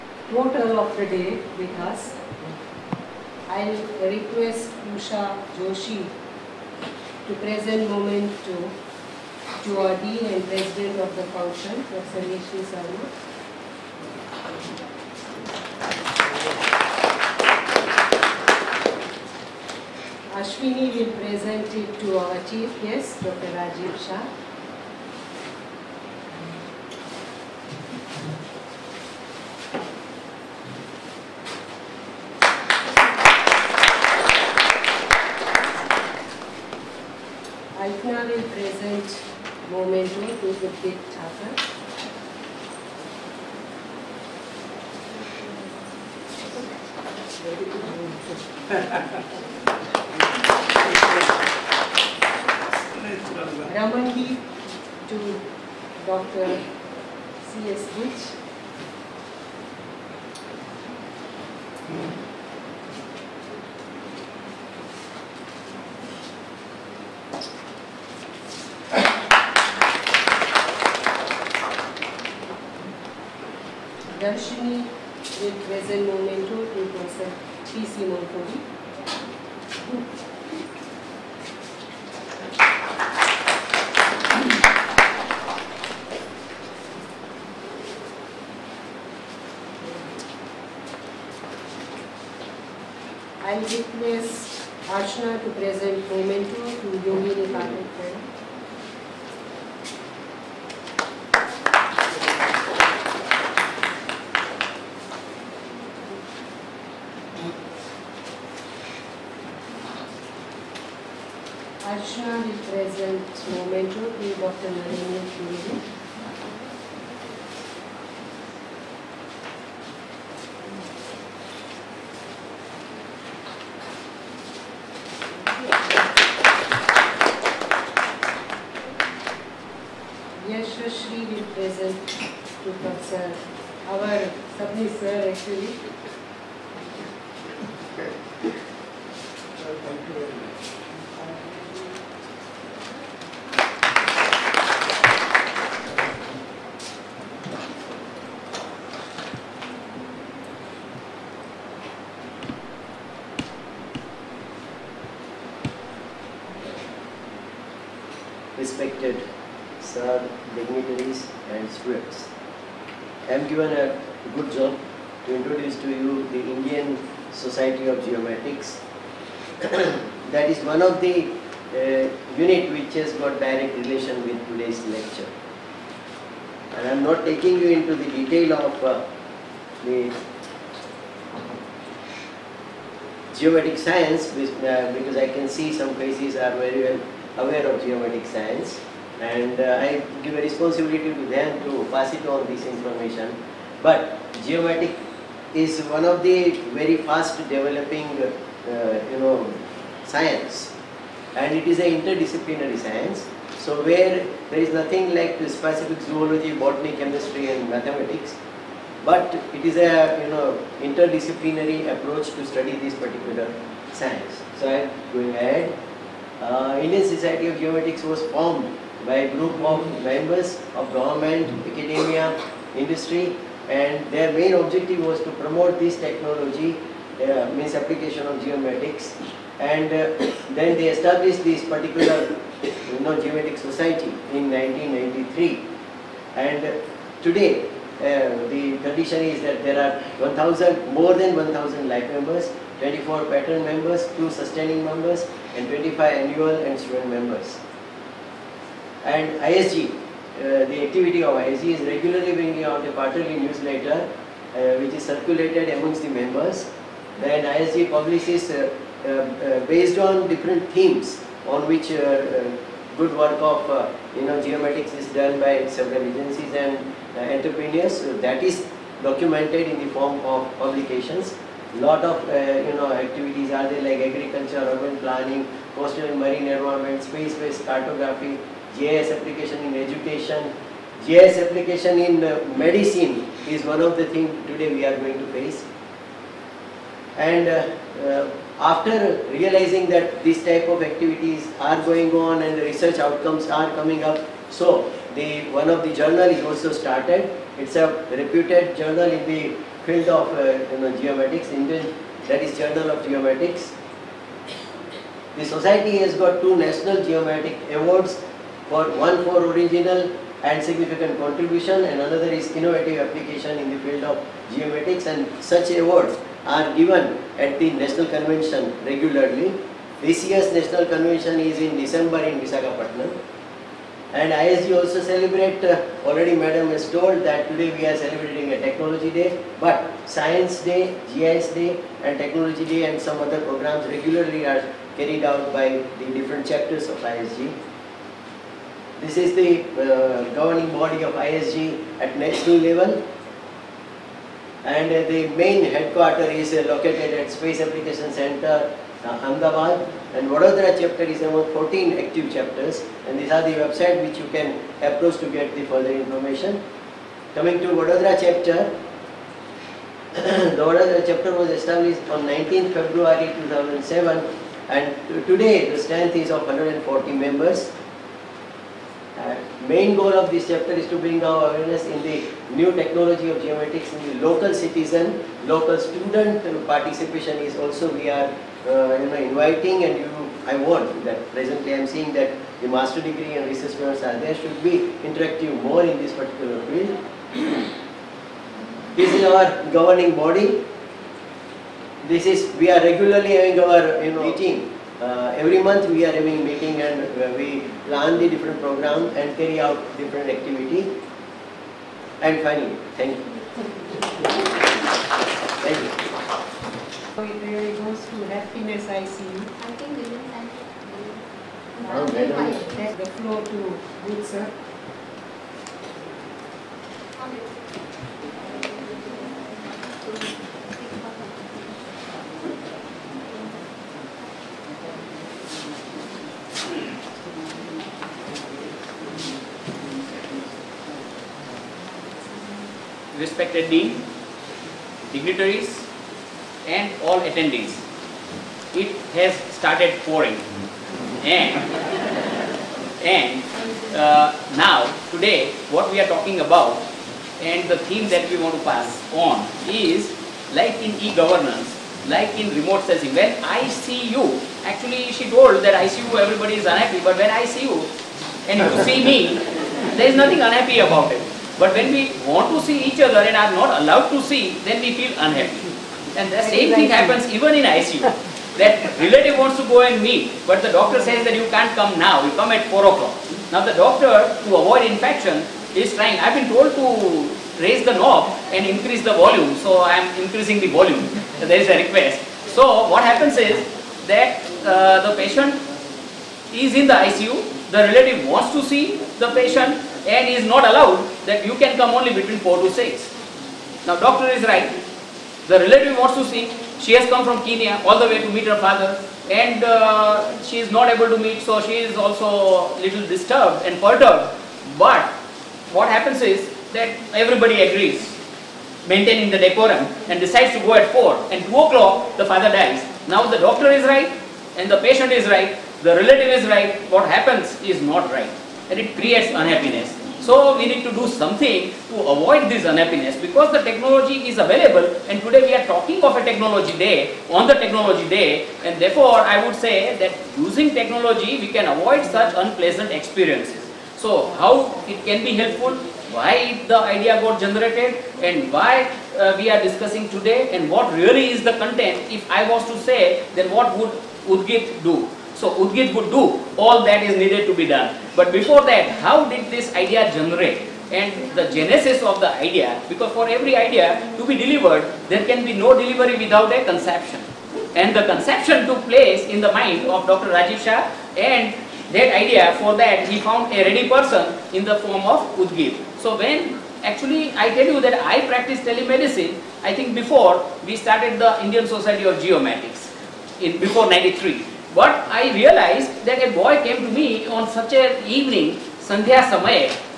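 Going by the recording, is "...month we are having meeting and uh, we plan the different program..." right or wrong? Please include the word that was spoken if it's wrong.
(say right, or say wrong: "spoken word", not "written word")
right.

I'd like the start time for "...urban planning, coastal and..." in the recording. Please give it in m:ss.
4:34.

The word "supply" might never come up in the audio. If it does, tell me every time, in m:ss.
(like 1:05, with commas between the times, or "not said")
not said.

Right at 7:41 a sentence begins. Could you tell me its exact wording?
But when we want to see each other and are not allowed to see, then we feel unhappy.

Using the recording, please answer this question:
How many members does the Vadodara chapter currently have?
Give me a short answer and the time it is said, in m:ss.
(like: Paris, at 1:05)
140, at 6:06.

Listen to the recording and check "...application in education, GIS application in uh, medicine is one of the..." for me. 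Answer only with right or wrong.
right.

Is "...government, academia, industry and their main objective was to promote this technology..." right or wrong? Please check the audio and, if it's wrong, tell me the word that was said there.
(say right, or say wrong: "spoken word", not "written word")
right.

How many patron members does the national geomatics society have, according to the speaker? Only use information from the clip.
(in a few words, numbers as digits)
24.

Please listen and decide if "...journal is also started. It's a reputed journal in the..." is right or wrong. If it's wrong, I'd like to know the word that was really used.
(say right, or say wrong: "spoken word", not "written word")
right.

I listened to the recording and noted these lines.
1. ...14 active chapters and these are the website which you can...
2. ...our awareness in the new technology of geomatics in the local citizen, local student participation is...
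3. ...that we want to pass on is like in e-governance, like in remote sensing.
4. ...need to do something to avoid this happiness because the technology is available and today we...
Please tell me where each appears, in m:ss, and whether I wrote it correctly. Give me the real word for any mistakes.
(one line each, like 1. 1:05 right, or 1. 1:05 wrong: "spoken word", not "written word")
1. 5:51 right
2. 6:11 right
3. 7:28 right
4. 8:40 wrong: "unhappiness", not "happiness".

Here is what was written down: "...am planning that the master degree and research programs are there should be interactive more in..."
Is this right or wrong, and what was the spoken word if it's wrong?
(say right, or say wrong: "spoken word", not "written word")
wrong: "seeing", not "planning".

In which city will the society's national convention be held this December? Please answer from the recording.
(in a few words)
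Visakhapatnam.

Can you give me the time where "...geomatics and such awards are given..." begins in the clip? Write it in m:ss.
5:14.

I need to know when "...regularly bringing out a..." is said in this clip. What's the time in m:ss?
4:11.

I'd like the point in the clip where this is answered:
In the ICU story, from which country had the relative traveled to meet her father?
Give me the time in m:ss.
8:17.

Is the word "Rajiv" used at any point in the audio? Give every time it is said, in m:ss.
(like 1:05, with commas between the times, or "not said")
0:23, 9:20.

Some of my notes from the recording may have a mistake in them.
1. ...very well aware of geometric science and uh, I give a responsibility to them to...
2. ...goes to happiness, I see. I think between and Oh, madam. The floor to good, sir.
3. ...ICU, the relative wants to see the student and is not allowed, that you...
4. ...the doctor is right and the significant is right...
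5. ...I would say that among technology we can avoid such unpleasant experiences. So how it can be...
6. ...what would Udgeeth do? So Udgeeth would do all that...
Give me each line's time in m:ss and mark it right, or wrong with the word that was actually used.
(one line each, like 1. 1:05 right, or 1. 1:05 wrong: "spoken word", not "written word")
1. 3:06 right
2. 6:47 wrong: "women", not "between"
3. 8:06 wrong: "patient", not "student"
4. 8:33 wrong: "patient", not "significant"
5. 8:49 wrong: "using", not "among"
6. 9:03 right.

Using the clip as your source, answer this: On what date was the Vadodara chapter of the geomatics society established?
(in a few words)
19 February 2007.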